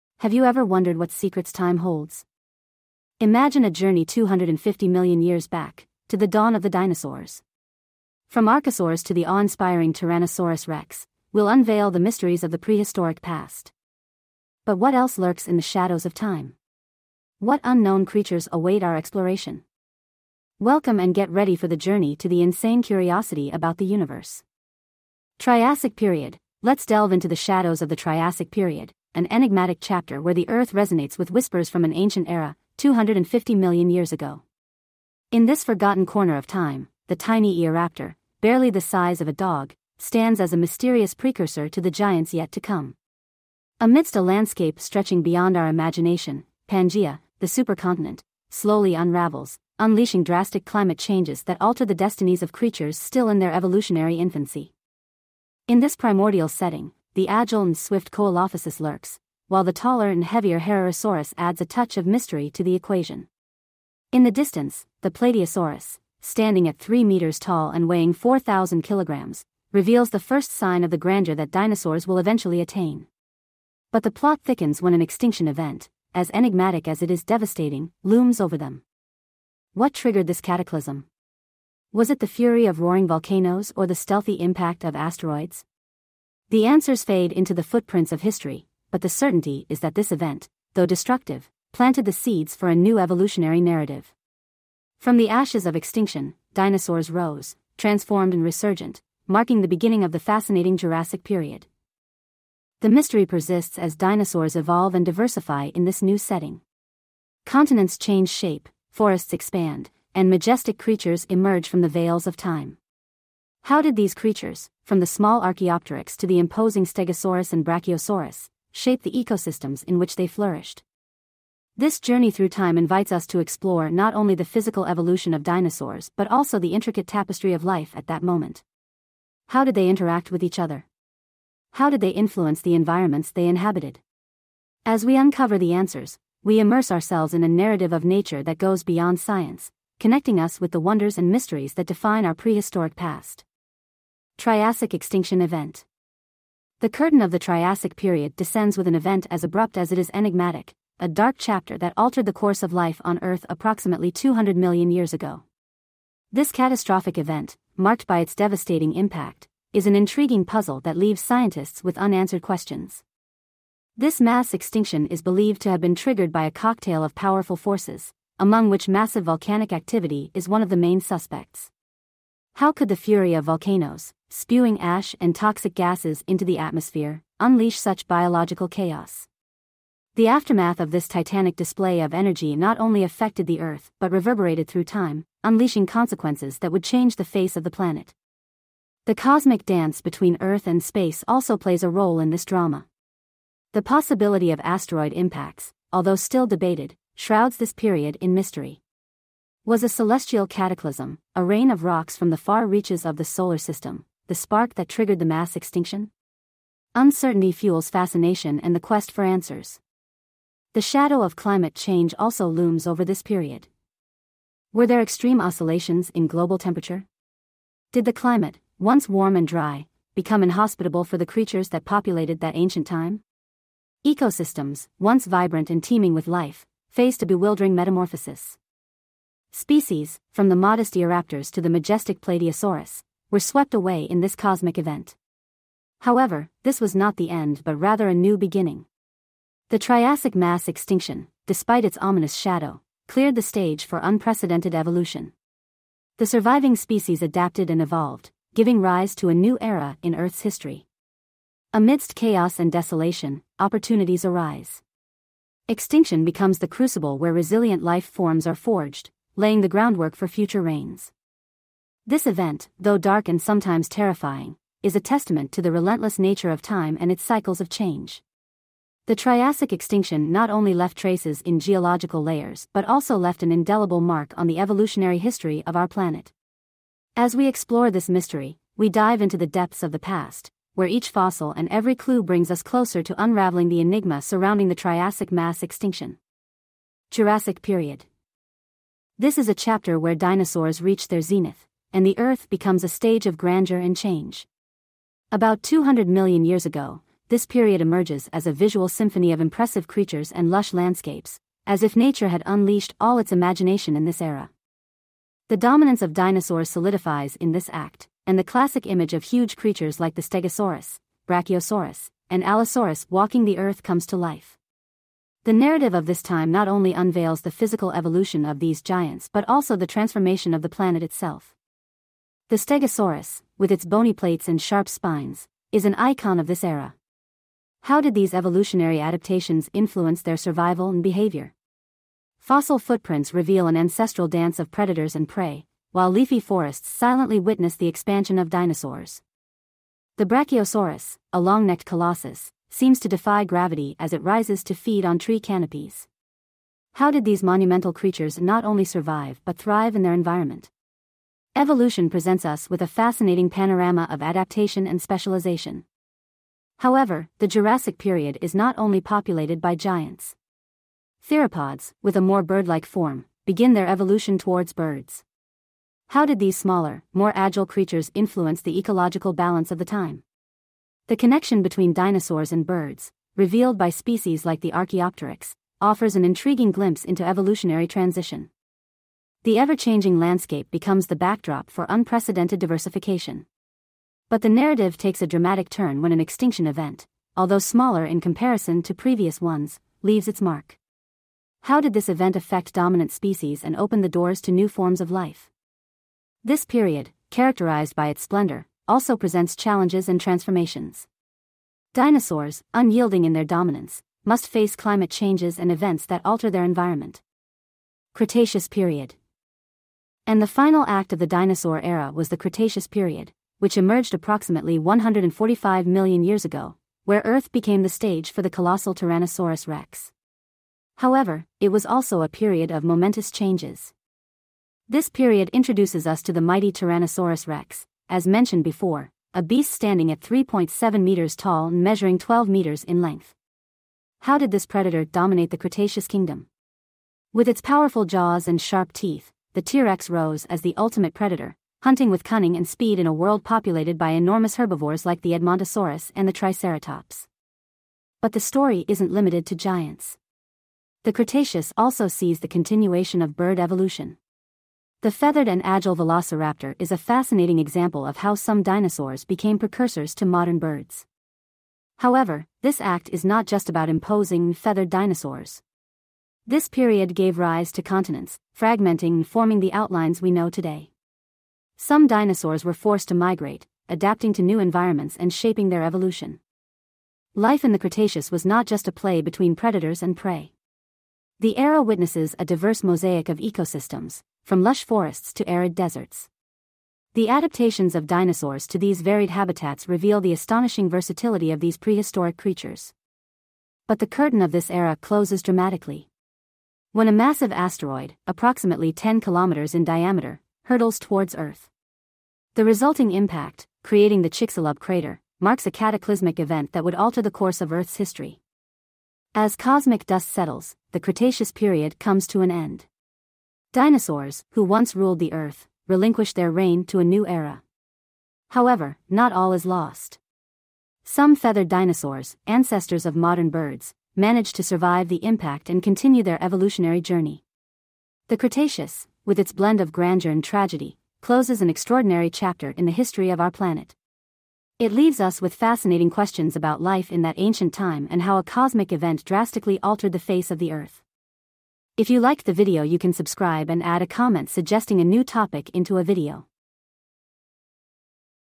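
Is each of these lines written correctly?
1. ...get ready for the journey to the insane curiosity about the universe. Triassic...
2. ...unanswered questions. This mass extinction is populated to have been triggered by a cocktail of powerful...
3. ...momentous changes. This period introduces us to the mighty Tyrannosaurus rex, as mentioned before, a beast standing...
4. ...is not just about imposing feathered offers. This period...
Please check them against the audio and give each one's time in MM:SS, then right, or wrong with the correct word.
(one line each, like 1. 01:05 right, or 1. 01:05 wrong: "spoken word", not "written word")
1. 00:21 right
2. 02:41 wrong: "believed", not "populated"
3. 07:02 right
4. 07:43 wrong: "dinosaurs", not "offers".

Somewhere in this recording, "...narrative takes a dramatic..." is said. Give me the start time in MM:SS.
06:24.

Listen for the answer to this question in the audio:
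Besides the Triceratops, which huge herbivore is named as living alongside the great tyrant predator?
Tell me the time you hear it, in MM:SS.
07:25.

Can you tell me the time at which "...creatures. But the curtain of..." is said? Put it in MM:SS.
08:12.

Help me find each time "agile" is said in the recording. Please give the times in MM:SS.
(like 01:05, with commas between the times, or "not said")
00:57, 06:07, 07:35.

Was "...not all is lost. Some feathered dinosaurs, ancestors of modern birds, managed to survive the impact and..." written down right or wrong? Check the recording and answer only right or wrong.
right.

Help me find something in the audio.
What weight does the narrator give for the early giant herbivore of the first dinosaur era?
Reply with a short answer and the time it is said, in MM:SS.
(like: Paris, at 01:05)
4,000 kilograms, at 01:08.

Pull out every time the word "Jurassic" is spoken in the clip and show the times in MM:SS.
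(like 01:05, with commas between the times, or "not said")
01:40, 04:47, 05:57.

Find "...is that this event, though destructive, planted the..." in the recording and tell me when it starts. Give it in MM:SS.
01:29.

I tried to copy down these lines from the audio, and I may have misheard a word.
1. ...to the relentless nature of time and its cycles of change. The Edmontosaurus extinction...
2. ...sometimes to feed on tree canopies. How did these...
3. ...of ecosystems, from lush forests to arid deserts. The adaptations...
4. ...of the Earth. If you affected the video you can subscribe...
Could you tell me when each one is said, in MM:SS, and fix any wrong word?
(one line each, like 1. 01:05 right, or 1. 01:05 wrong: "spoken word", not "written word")
1. 04:25 wrong: "Triassic", not "Edmontosaurus"
2. 05:44 wrong: "rises", not "sometimes"
3. 08:03 right
4. 09:00 wrong: "liked", not "affected".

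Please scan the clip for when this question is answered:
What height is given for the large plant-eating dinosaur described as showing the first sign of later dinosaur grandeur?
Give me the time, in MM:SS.
01:06.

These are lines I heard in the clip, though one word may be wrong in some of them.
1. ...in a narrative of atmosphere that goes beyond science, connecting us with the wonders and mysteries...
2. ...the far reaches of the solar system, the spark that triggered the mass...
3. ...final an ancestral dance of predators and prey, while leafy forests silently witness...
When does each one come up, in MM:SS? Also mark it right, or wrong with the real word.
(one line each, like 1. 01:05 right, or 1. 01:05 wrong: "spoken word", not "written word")
1. 02:17 wrong: "nature", not "atmosphere"
2. 03:22 right
3. 05:33 wrong: "reveal", not "final".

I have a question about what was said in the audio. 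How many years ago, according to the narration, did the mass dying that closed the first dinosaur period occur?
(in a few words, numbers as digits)
About 200 million years ago.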